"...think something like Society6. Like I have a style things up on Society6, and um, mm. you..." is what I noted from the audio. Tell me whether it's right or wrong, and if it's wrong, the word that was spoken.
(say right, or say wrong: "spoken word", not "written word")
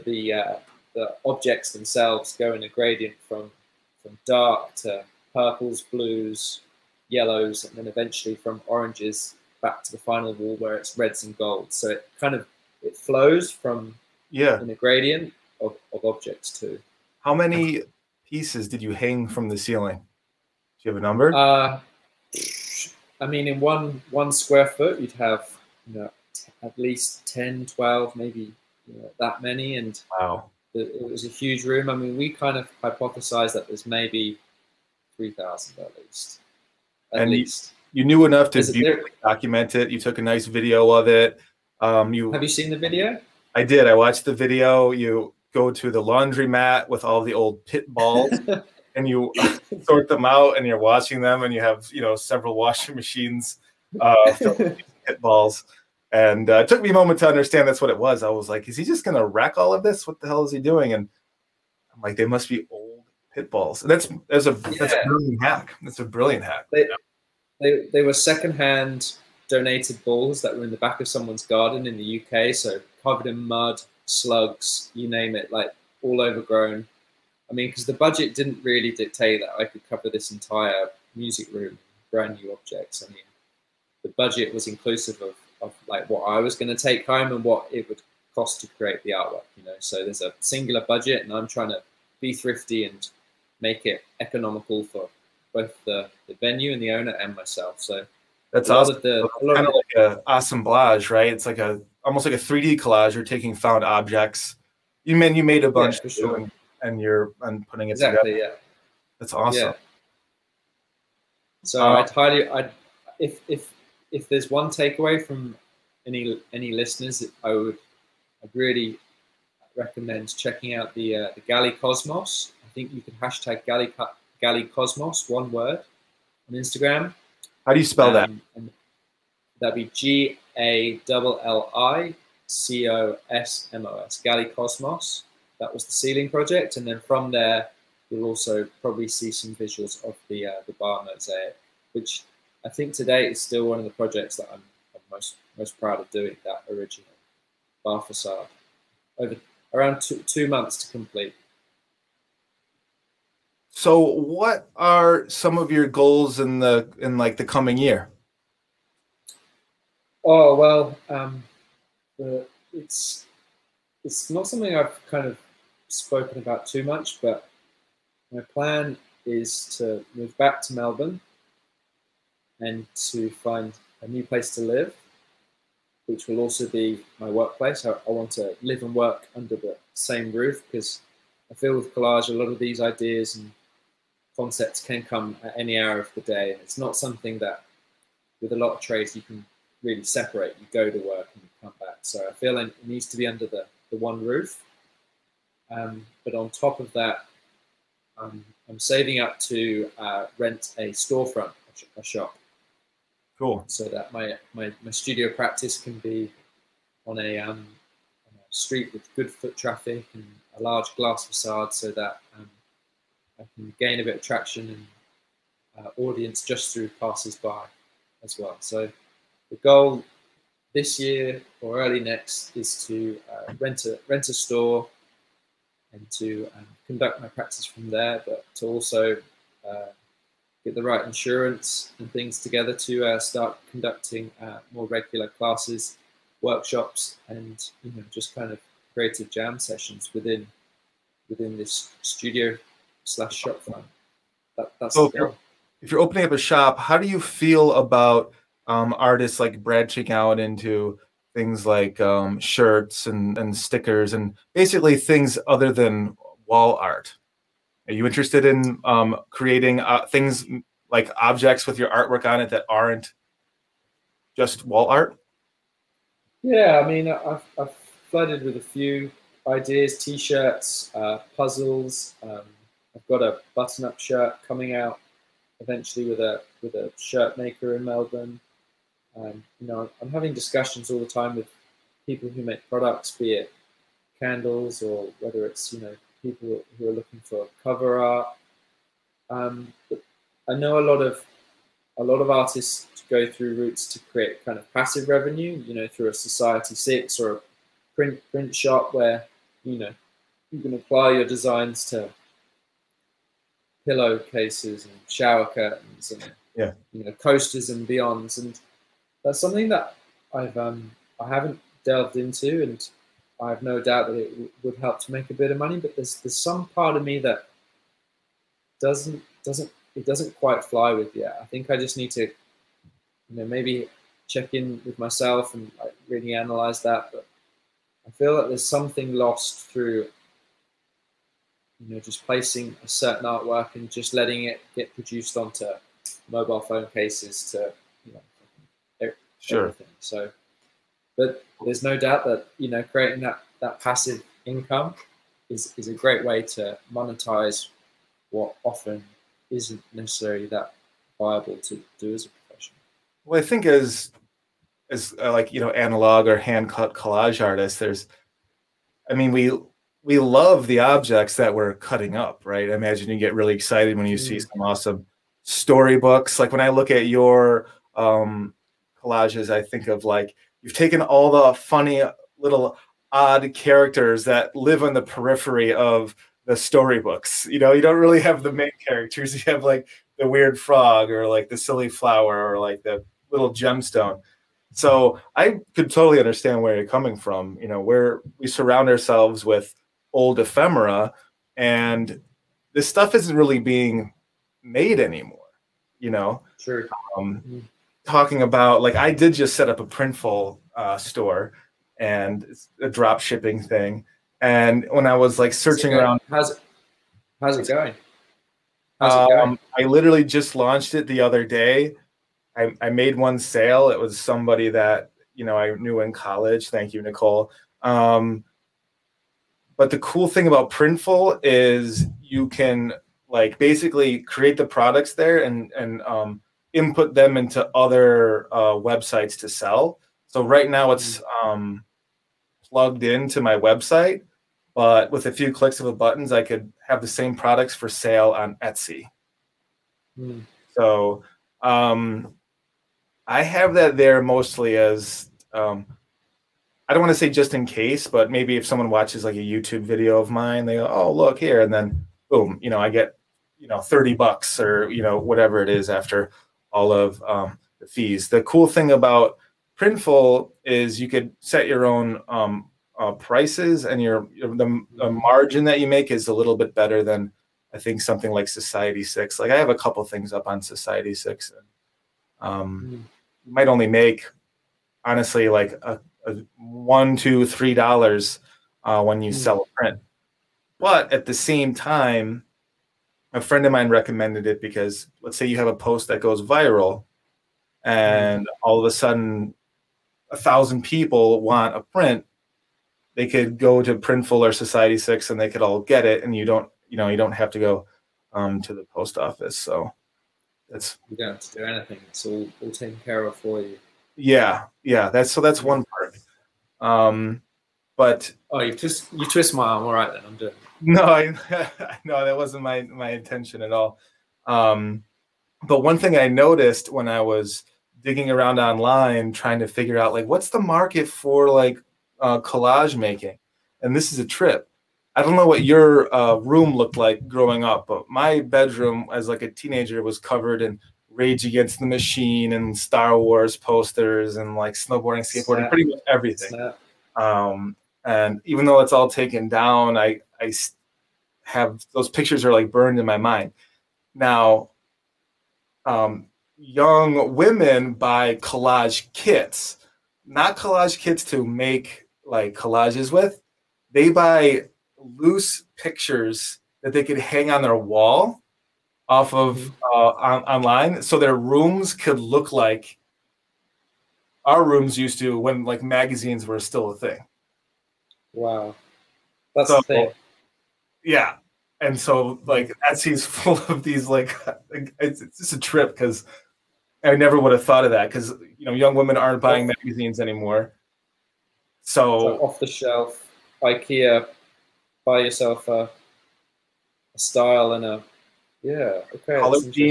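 wrong: "couple", not "style".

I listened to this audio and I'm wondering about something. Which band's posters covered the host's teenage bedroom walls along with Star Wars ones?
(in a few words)
Rage Against the Machine.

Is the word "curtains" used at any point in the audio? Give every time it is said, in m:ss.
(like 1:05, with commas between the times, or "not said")
5:05.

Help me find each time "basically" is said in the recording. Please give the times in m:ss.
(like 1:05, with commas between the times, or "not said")
4:14, 7:03.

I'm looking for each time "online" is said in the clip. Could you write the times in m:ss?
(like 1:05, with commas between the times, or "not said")
8:38, 9:20.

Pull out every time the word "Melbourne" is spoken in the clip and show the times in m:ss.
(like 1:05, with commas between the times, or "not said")
2:50, 4:37.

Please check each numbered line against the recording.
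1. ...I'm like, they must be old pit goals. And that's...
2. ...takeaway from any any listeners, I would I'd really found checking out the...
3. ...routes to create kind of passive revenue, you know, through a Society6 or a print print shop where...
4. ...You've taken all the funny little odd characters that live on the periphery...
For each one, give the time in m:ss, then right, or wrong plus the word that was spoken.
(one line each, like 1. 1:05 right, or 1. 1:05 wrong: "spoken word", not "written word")
1. 1:01 wrong: "balls", not "goals"
2. 1:54 wrong: "recommend", not "found"
3. 4:53 right
4. 6:10 right.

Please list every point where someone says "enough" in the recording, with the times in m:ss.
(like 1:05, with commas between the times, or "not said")
0:38.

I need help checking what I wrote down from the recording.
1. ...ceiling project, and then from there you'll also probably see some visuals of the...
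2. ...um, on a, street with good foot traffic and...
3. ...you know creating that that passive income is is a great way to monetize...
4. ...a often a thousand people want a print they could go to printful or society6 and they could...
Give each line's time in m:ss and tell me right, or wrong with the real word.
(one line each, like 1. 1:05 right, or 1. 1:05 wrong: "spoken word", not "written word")
1. 2:15 right
2. 3:27 right
3. 5:42 right
4. 8:08 wrong: "sudden", not "often".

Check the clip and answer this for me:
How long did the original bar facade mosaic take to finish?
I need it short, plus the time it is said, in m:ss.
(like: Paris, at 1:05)
two months, at 2:30.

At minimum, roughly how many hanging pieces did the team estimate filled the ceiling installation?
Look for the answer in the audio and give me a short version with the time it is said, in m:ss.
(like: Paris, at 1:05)
3,000, at 0:35.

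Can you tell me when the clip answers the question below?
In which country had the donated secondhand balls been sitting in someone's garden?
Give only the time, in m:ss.
1:12.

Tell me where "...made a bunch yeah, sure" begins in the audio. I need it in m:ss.
1:45.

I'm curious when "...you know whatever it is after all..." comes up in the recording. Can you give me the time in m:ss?
7:34.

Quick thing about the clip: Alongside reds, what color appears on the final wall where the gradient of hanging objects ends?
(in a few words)
golds.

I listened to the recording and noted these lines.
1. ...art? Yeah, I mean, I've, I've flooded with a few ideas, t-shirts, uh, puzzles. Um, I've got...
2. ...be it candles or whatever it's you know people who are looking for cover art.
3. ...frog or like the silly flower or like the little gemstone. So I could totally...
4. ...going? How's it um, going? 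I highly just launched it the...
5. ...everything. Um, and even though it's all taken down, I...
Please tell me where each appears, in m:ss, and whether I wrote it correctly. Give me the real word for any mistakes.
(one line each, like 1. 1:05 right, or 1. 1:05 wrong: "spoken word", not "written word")
1. 4:24 right
2. 4:43 wrong: "whether", not "whatever"
3. 6:20 right
4. 6:47 wrong: "literally", not "highly"
5. 8:56 right.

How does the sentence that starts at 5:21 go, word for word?
I think I just need to, you know, maybe check in with myself and like, really analyze that.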